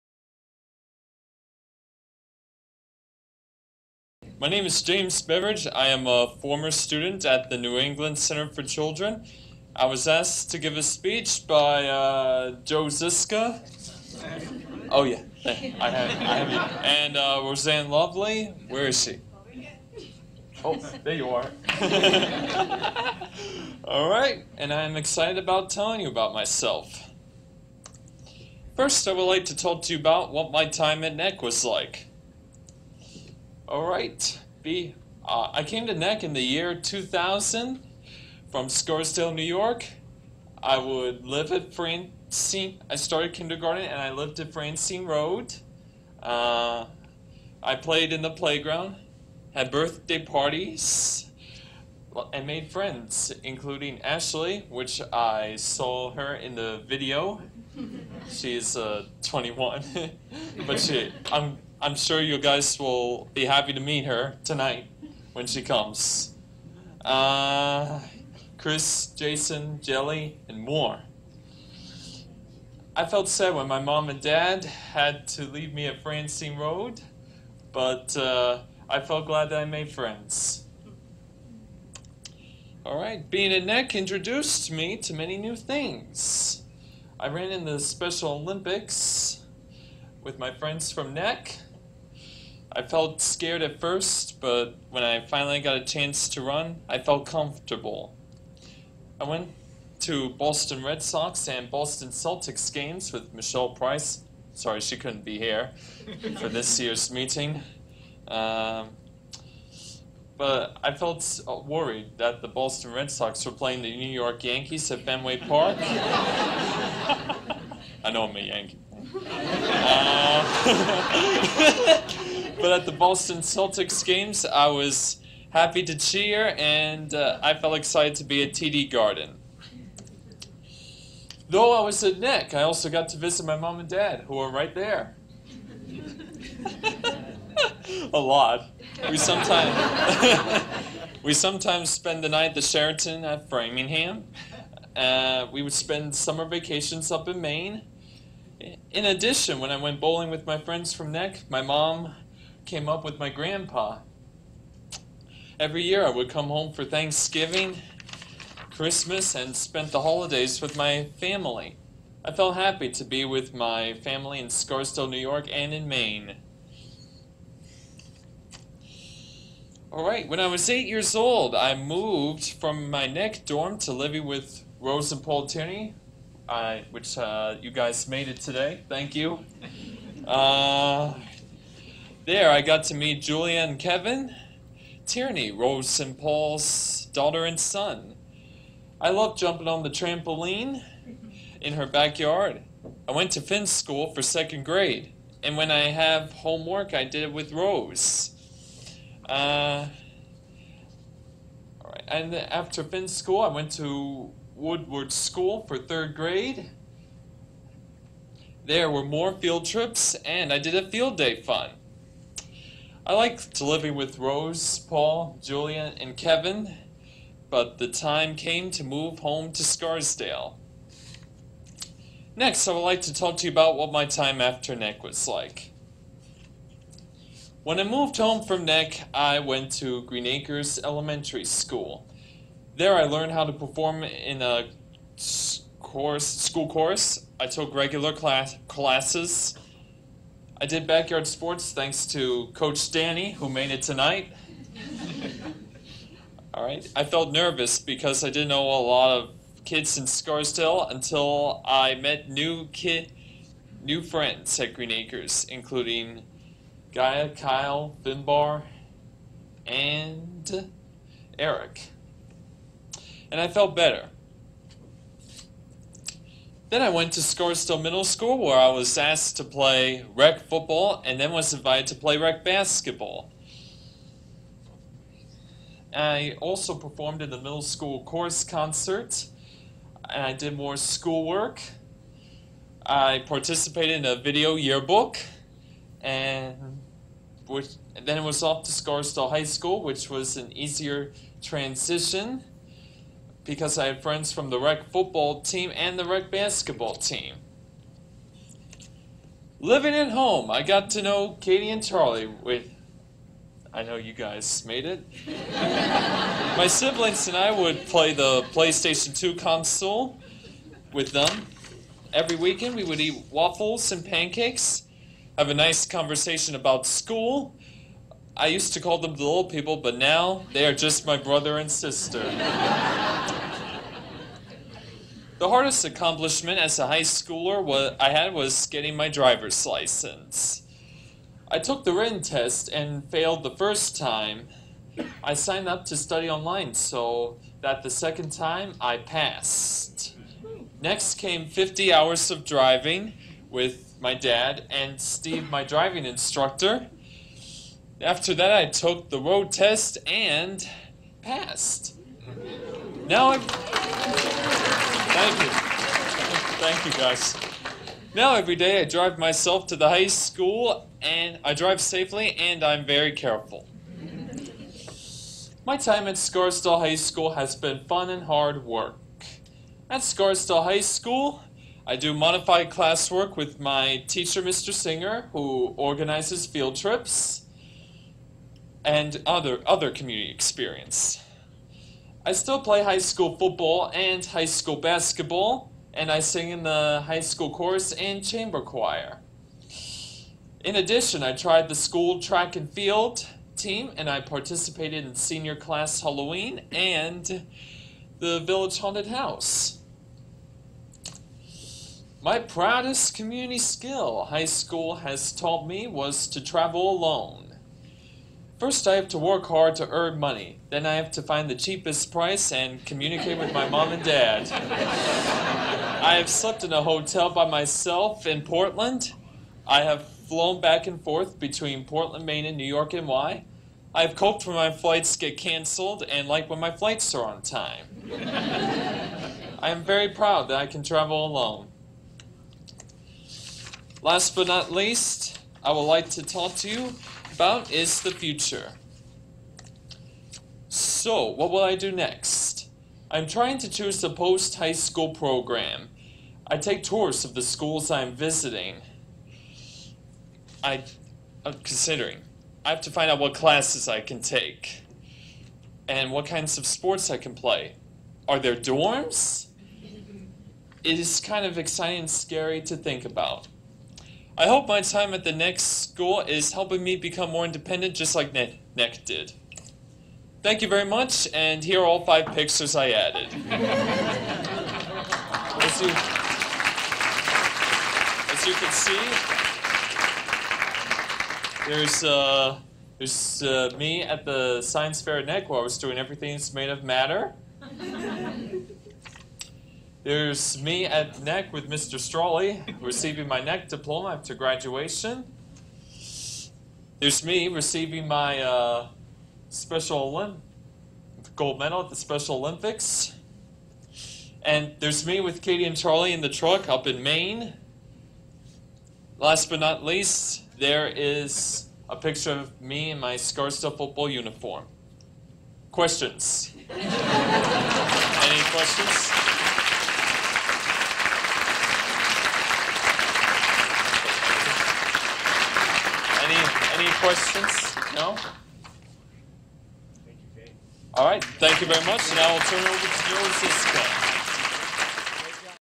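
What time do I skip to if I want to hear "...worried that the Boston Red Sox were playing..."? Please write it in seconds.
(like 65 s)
111 s.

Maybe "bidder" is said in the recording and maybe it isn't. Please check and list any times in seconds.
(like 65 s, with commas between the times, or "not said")
not said.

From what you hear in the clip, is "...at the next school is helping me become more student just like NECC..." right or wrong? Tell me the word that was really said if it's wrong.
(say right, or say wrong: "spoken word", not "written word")
wrong: "independent", not "student".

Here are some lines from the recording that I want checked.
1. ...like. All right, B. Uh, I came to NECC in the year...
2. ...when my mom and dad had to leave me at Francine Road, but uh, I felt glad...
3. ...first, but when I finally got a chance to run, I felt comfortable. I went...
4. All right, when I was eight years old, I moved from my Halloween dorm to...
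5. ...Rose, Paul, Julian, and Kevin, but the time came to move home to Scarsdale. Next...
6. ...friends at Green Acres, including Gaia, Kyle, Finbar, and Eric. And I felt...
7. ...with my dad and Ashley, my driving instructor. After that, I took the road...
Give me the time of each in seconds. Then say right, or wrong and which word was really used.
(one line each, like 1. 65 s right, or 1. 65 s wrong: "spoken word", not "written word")
1. 31 s right
2. 73 s right
3. 93 s right
4. 169 s wrong: "NECC", not "Halloween"
5. 214 s right
6. 254 s right
7. 343 s wrong: "Steve", not "Ashley".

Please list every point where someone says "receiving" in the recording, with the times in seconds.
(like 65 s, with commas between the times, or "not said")
492 s, 497 s.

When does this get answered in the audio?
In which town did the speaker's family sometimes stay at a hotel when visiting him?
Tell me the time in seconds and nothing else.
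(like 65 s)
143 s.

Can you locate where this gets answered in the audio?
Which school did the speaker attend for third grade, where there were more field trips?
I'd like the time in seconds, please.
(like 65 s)
204 s.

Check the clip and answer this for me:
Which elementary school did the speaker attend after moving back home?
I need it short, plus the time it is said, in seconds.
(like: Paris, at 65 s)
Green Acres Elementary School, at 230 s.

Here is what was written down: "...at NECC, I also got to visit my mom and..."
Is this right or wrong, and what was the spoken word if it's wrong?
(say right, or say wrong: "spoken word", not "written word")
right.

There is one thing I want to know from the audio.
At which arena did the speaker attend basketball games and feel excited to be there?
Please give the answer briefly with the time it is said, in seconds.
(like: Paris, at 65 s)
TD Garden, at 128 s.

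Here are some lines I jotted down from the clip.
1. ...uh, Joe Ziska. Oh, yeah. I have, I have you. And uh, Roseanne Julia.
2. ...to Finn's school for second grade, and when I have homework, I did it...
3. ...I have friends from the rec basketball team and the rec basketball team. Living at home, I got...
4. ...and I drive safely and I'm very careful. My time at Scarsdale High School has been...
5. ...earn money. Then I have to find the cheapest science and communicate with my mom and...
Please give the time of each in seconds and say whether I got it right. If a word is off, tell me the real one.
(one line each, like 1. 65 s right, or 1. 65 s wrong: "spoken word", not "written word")
1. 11 s wrong: "Lovely", not "Julia"
2. 193 s right
3. 293 s wrong: "football", not "basketball"
4. 361 s right
5. 409 s wrong: "price", not "science".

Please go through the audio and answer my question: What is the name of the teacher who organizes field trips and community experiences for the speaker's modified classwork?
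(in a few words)
Mr. Singer.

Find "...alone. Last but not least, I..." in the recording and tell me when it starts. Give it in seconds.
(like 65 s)
431 s.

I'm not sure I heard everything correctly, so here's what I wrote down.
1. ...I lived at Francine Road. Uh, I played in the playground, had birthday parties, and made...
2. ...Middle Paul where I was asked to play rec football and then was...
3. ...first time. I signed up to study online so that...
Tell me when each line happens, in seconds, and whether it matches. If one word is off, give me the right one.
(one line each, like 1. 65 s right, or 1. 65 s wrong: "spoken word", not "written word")
1. 44 s right
2. 267 s wrong: "School", not "Paul"
3. 333 s right.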